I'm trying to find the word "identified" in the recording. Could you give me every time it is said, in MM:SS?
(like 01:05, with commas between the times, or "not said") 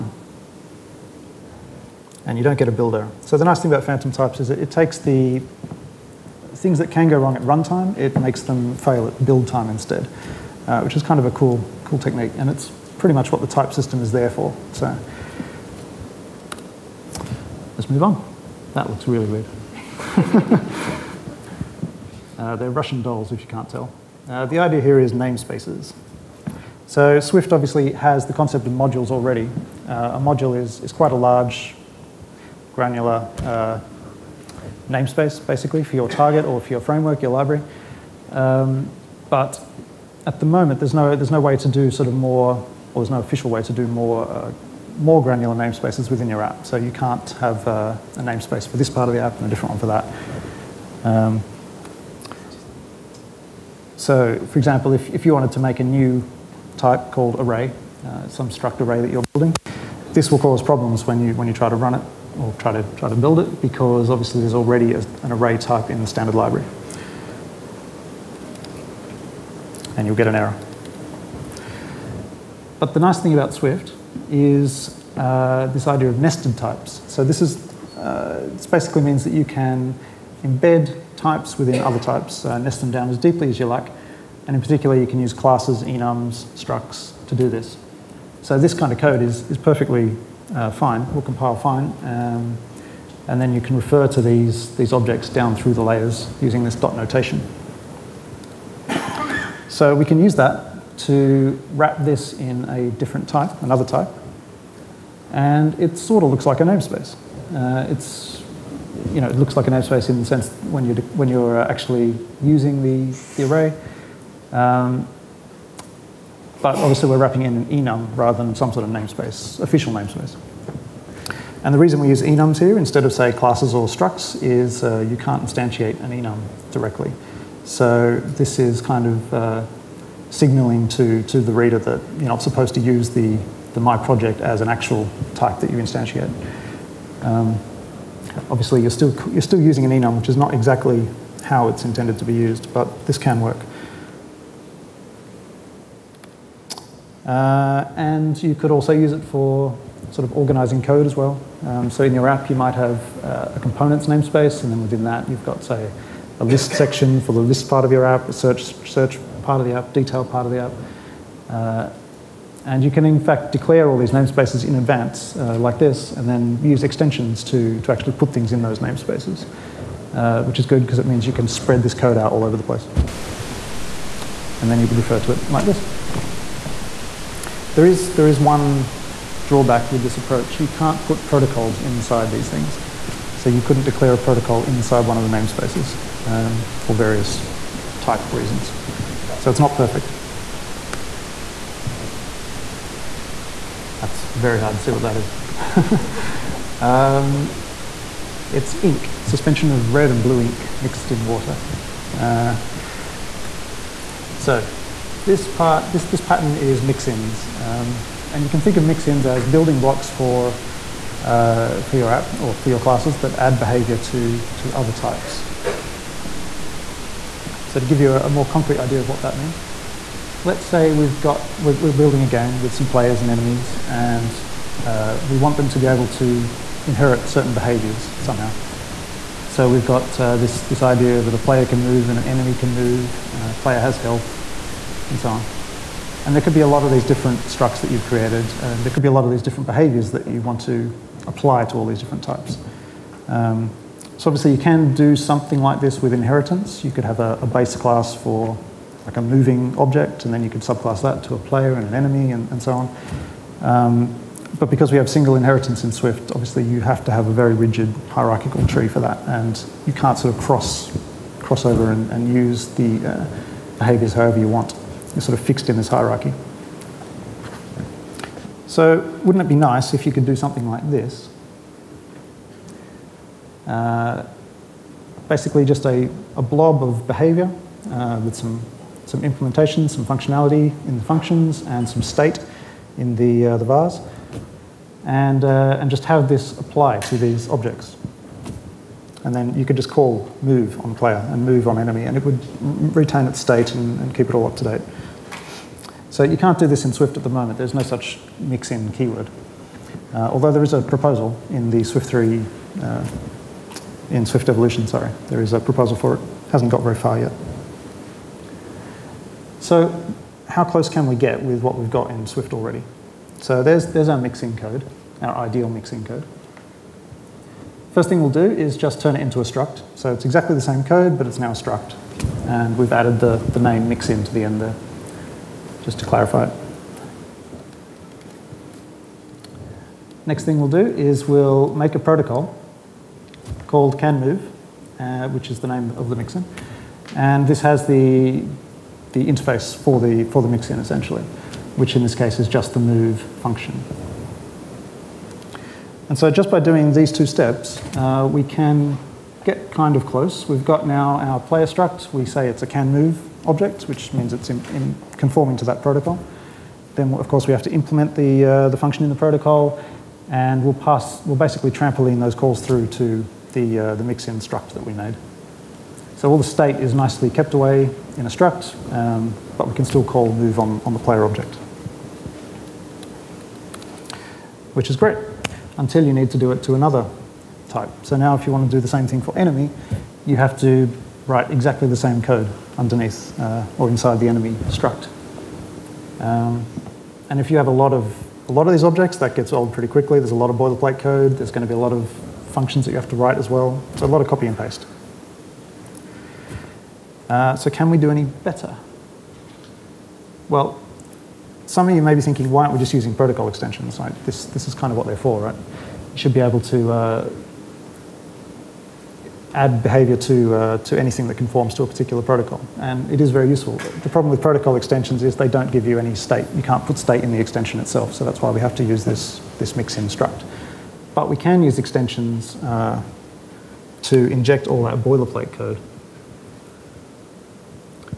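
not said.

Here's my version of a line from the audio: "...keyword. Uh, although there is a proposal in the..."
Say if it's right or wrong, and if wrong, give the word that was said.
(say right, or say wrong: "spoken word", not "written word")
right.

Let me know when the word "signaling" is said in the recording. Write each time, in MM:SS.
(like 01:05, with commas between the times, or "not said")
02:10.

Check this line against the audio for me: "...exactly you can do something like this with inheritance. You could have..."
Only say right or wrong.
wrong.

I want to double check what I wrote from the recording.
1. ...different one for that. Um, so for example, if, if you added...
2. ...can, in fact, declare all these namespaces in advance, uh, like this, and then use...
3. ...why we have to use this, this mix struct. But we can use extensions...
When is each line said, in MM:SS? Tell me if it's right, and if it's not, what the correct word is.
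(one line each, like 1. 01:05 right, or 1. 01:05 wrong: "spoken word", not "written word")
1. 00:49 wrong: "wanted", not "added"
2. 02:42 right
3. 06:58 right.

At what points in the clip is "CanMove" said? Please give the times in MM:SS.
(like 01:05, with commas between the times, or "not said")
05:33, 05:52.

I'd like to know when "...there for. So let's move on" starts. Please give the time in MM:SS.
00:14.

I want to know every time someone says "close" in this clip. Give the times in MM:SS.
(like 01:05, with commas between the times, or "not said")
05:10, 05:50.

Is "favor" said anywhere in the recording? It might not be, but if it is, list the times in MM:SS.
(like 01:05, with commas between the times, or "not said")
not said.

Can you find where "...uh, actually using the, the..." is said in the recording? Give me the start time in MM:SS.
01:51.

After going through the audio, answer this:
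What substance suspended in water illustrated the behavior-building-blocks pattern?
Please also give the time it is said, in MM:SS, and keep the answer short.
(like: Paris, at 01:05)
red and blue ink, at 03:19.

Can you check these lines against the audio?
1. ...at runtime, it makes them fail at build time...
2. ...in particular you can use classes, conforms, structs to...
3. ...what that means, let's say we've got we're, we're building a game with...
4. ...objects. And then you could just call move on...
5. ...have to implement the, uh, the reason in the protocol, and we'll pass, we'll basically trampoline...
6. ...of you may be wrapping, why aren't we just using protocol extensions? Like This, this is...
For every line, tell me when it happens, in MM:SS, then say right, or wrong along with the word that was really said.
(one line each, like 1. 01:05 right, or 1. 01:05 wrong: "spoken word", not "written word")
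1. 00:07 right
2. 01:24 wrong: "enums", not "conforms"
3. 03:39 right
4. 04:47 right
5. 05:57 wrong: "function", not "reason"
6. 06:41 wrong: "thinking", not "wrapping".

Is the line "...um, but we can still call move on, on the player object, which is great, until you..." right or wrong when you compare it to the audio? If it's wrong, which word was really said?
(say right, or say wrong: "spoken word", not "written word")
right.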